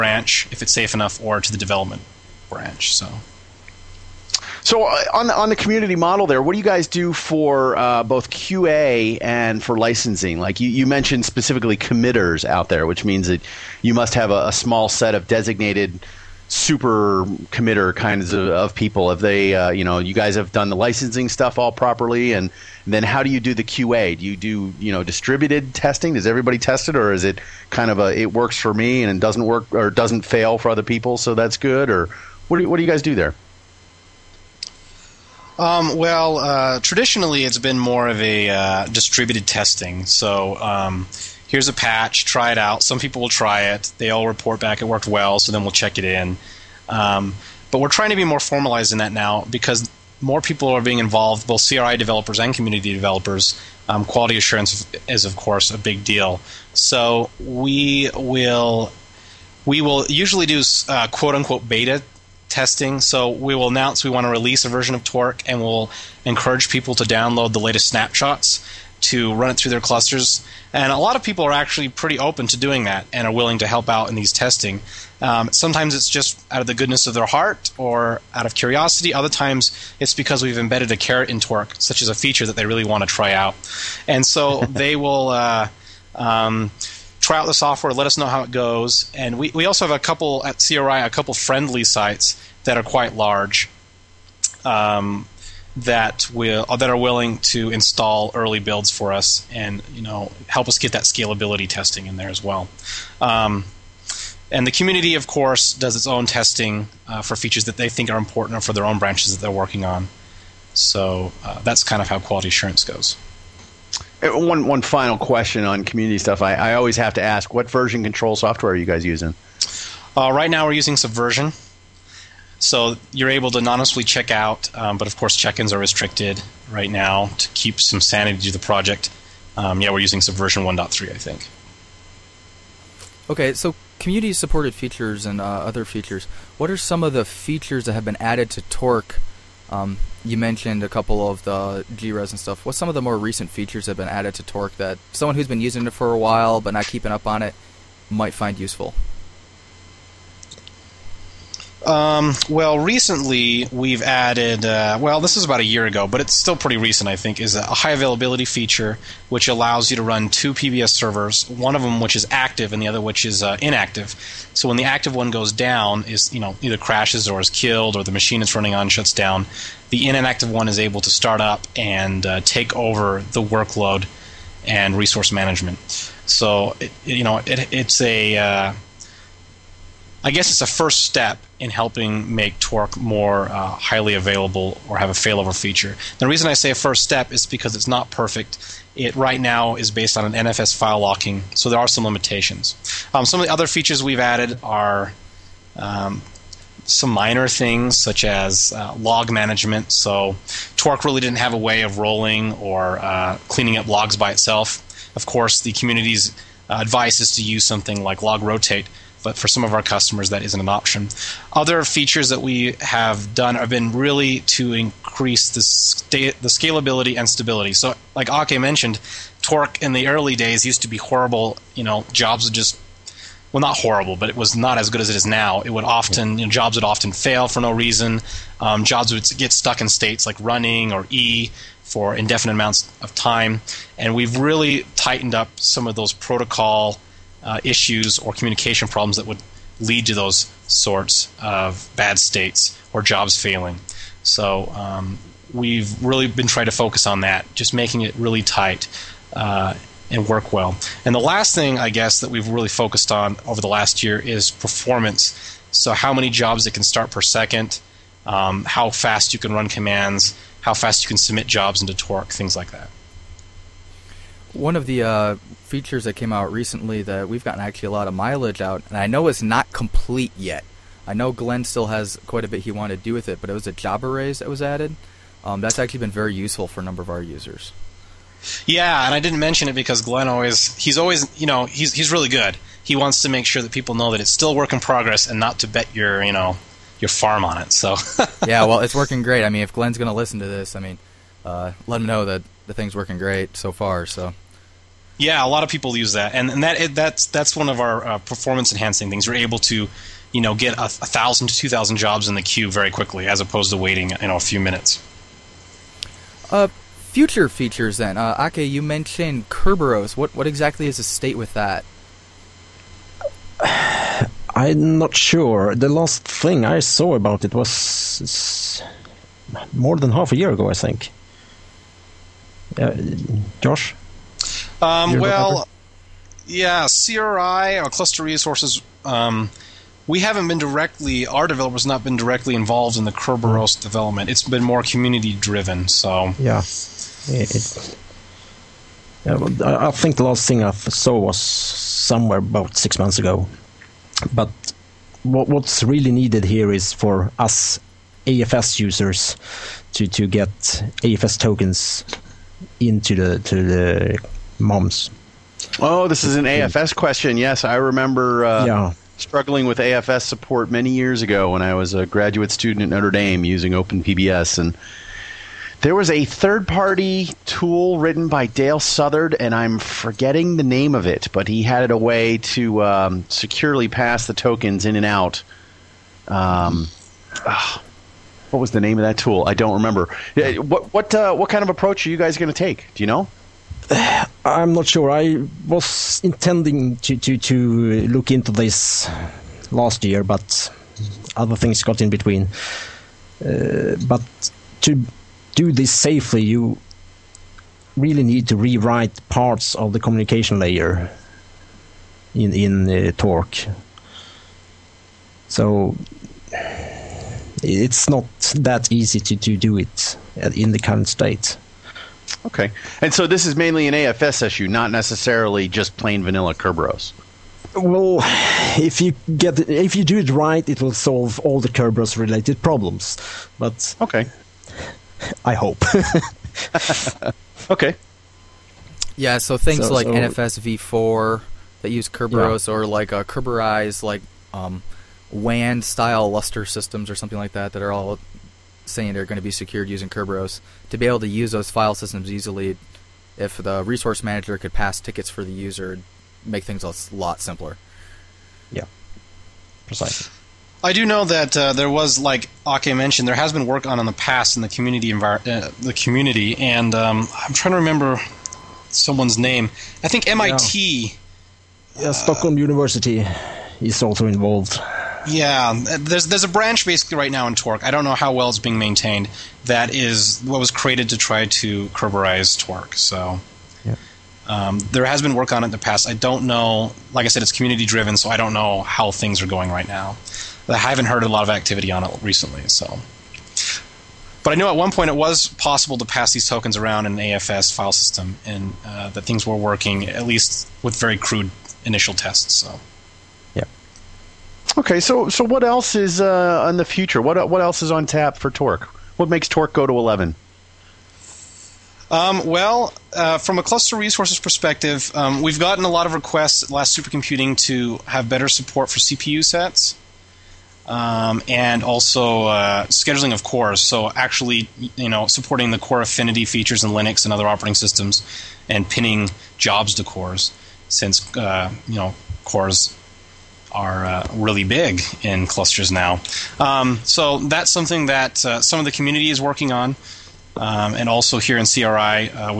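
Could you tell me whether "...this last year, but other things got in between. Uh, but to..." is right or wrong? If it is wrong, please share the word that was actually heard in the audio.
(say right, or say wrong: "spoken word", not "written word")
right.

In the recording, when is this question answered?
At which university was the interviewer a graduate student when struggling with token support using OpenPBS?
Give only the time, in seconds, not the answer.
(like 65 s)
362 s.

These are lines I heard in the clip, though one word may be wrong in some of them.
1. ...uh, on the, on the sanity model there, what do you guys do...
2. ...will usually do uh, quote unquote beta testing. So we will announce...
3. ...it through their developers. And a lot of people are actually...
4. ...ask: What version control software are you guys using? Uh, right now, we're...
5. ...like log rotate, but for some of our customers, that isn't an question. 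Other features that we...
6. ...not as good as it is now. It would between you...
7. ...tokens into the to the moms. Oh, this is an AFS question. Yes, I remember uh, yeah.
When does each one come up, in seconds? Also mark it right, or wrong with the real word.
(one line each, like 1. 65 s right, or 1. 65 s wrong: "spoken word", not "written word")
1. 4 s wrong: "community", not "sanity"
2. 59 s right
3. 69 s wrong: "clusters", not "developers"
4. 117 s right
5. 208 s wrong: "option", not "question"
6. 224 s wrong: "often", not "between"
7. 351 s right.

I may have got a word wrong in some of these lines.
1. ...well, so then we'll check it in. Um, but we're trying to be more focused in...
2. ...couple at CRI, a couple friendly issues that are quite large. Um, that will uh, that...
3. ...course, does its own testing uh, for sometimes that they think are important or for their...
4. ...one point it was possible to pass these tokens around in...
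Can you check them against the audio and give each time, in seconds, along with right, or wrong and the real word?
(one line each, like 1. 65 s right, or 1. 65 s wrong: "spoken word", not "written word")
1. 45 s wrong: "formalized", not "focused"
2. 89 s wrong: "sites", not "issues"
3. 105 s wrong: "features", not "sometimes"
4. 484 s right.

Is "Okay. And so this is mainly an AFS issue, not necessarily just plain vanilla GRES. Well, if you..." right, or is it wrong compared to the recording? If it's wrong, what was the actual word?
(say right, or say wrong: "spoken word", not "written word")
wrong: "Kerberos", not "GRES".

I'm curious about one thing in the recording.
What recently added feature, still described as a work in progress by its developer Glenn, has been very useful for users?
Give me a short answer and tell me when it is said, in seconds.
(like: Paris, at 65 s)
Job arrays, at 273 s.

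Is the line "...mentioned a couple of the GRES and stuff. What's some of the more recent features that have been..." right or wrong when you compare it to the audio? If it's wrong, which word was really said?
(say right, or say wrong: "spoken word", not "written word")
right.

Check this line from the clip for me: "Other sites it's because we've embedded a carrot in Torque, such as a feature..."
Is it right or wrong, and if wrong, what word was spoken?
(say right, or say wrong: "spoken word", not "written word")
wrong: "times", not "sites".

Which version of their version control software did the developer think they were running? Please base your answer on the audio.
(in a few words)
1.3.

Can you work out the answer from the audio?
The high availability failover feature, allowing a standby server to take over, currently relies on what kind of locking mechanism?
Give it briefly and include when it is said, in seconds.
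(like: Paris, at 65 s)
NFS file locking, at 190 s.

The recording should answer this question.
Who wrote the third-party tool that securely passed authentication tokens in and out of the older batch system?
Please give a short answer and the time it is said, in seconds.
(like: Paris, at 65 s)
Dale Southard, at 368 s.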